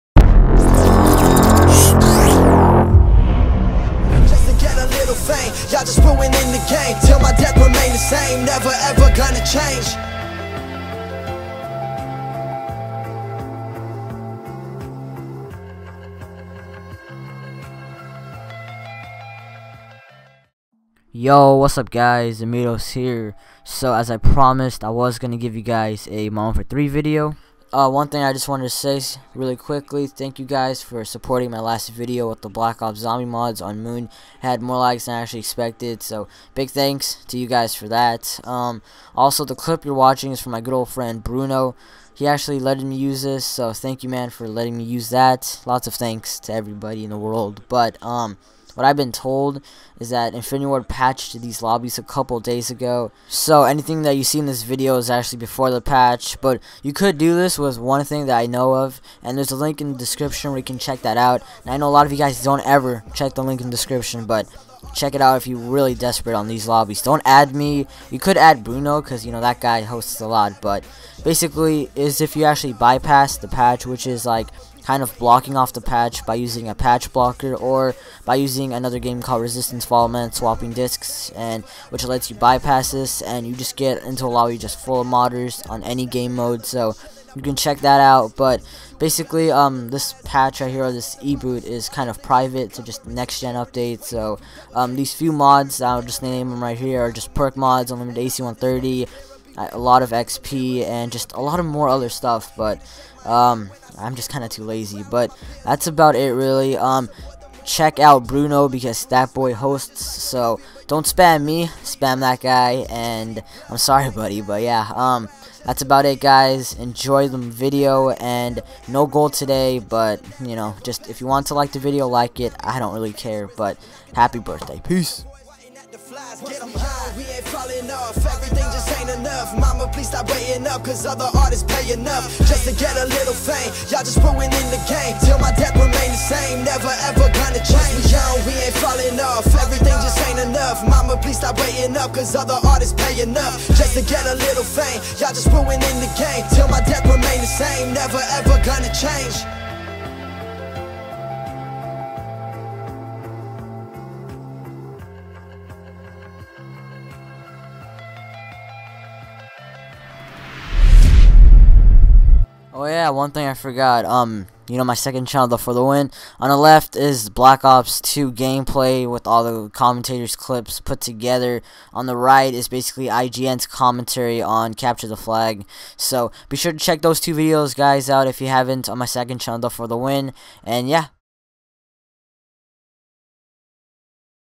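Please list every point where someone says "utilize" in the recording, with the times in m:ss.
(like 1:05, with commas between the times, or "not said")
not said.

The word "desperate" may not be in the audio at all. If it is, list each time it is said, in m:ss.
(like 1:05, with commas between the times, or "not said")
1:05.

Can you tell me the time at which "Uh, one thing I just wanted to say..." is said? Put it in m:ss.
0:27.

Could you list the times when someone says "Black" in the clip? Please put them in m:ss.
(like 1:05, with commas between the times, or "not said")
0:32, 2:47.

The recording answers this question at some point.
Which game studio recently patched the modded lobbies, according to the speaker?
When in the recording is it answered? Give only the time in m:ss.
0:50.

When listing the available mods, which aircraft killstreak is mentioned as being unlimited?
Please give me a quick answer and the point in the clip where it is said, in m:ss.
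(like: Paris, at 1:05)
AC 130, at 1:38.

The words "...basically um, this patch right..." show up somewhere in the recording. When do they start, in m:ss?
1:28.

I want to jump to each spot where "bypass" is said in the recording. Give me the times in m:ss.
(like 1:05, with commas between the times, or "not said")
1:12, 1:22.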